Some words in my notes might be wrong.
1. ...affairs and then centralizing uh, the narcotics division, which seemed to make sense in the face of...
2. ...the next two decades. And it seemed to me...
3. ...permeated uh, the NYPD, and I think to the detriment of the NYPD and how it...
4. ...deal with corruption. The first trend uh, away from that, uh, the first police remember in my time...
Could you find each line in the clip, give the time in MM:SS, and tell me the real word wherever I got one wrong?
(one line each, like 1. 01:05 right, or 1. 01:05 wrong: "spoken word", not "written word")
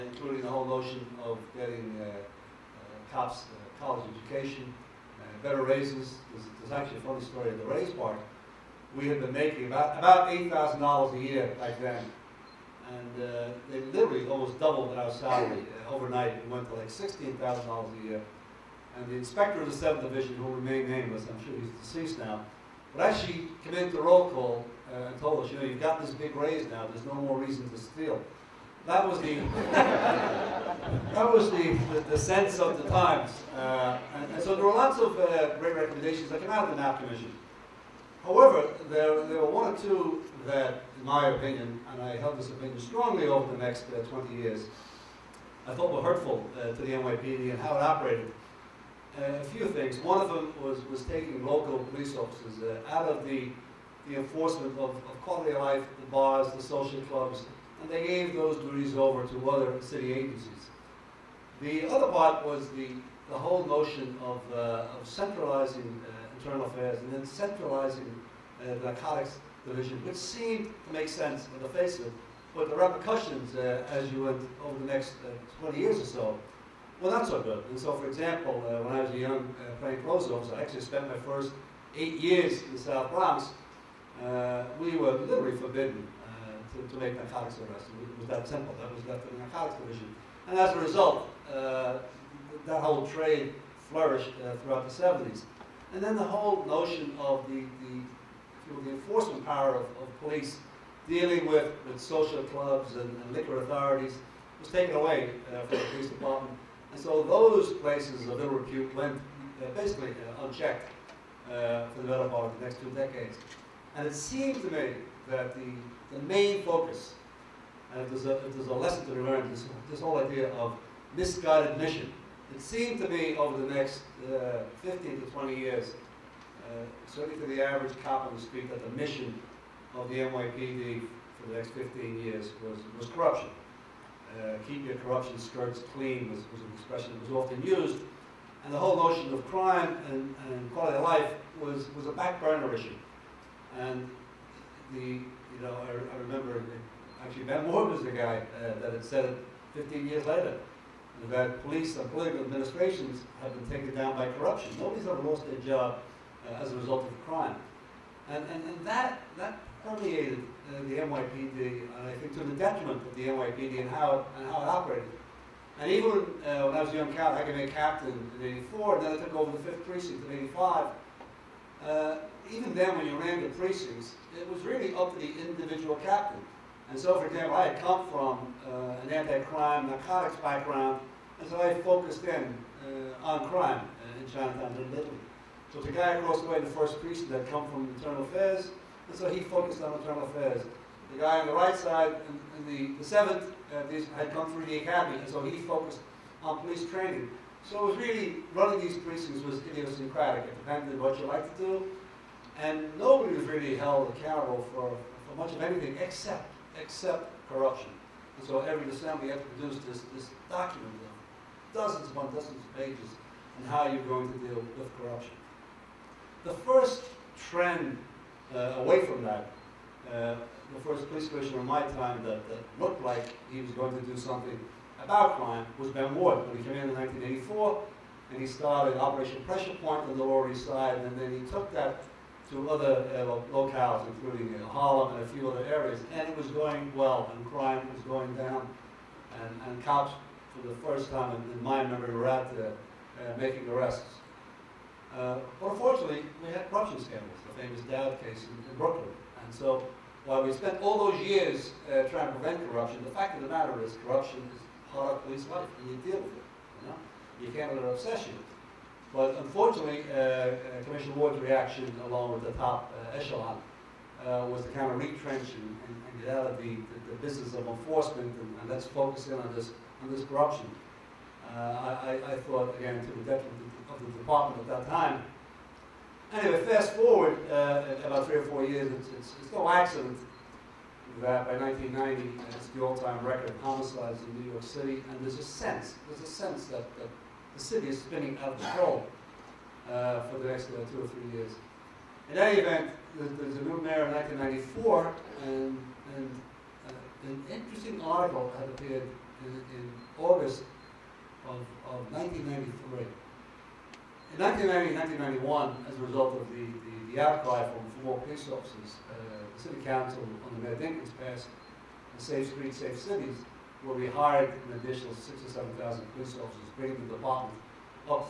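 1. 01:06 right
2. 01:52 right
3. 02:39 right
4. 03:34 wrong: "commissioner", not "remember".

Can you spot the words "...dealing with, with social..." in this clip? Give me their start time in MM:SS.
01:41.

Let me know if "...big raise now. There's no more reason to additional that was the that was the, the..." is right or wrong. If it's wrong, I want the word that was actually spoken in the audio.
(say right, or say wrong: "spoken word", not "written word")
wrong: "steal", not "additional".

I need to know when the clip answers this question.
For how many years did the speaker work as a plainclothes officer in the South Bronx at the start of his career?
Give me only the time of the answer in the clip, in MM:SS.
01:21.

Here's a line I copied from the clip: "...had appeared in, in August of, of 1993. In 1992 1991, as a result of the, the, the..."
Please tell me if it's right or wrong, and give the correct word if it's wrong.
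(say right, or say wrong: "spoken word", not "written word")
wrong: "1990", not "1992".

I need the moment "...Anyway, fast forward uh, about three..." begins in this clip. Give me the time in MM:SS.
04:36.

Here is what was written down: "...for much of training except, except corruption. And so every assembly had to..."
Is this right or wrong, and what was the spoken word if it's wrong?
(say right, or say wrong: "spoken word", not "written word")
wrong: "anything", not "training".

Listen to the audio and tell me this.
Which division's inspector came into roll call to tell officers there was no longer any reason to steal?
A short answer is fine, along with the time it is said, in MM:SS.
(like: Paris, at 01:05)
7th Division, at 00:19.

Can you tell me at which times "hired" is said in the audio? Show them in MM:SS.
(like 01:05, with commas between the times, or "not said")
05:14.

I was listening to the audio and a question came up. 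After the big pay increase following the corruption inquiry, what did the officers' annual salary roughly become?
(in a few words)
$16,000.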